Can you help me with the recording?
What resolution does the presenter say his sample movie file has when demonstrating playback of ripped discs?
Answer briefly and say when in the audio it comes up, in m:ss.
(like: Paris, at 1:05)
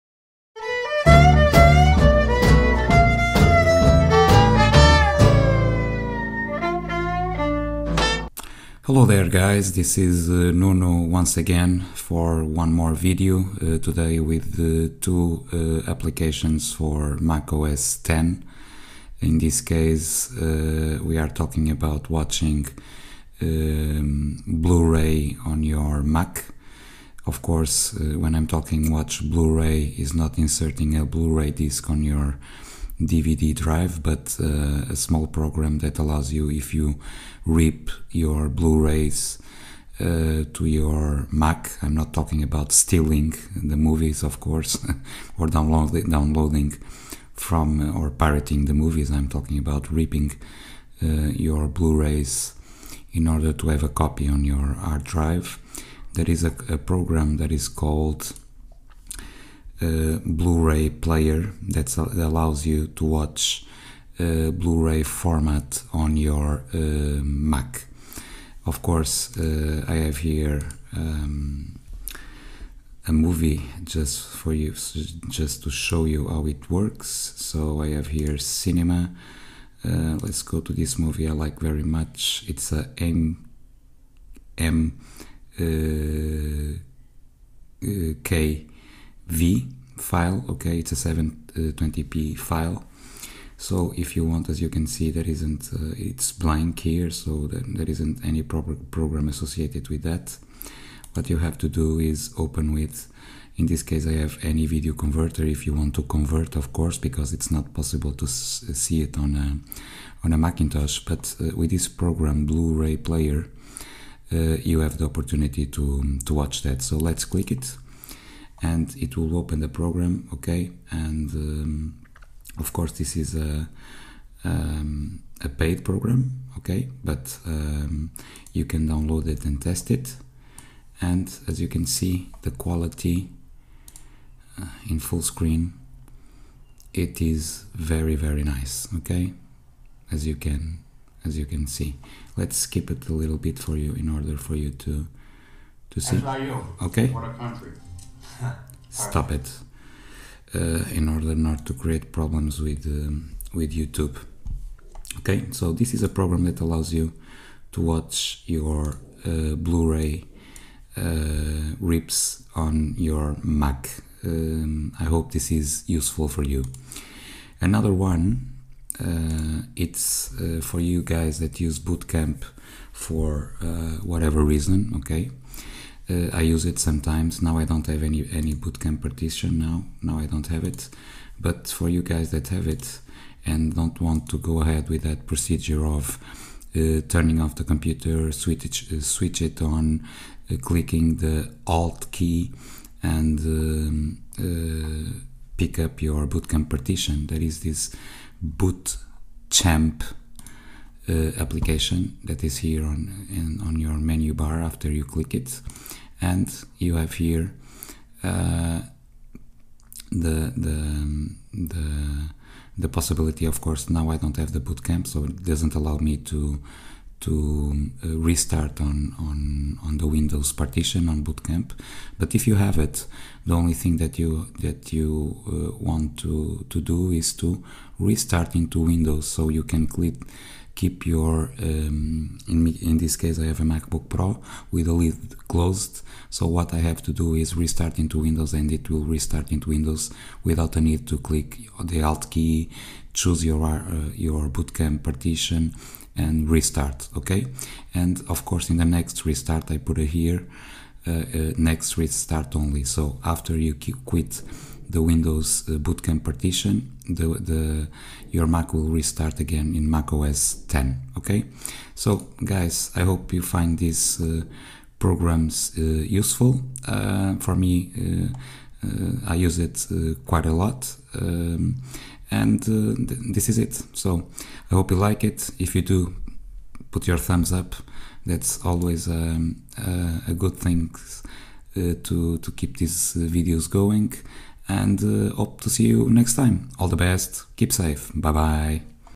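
720p, at 1:30.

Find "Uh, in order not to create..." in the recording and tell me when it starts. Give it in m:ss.
2:30.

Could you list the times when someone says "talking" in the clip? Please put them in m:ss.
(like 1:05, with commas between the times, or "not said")
0:21, 0:28, 0:42, 0:49.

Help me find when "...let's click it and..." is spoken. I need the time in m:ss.
1:56.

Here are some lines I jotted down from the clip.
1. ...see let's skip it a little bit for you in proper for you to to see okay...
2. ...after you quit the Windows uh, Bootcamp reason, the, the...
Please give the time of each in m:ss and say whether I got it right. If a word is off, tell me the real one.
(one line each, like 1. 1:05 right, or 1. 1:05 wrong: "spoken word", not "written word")
1. 2:21 wrong: "order", not "proper"
2. 4:13 wrong: "partition", not "reason".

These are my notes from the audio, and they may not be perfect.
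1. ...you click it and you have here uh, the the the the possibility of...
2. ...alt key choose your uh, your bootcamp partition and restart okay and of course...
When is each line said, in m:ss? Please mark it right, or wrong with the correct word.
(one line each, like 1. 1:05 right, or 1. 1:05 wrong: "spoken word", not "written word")
1. 3:24 right
2. 4:02 right.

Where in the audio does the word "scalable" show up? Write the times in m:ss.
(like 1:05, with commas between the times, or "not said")
not said.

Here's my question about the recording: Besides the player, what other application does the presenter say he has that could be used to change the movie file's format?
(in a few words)
Any Video Converter.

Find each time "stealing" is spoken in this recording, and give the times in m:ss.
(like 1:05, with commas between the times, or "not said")
0:42.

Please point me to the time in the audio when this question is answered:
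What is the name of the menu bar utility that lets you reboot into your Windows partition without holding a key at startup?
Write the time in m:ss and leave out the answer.
3:18.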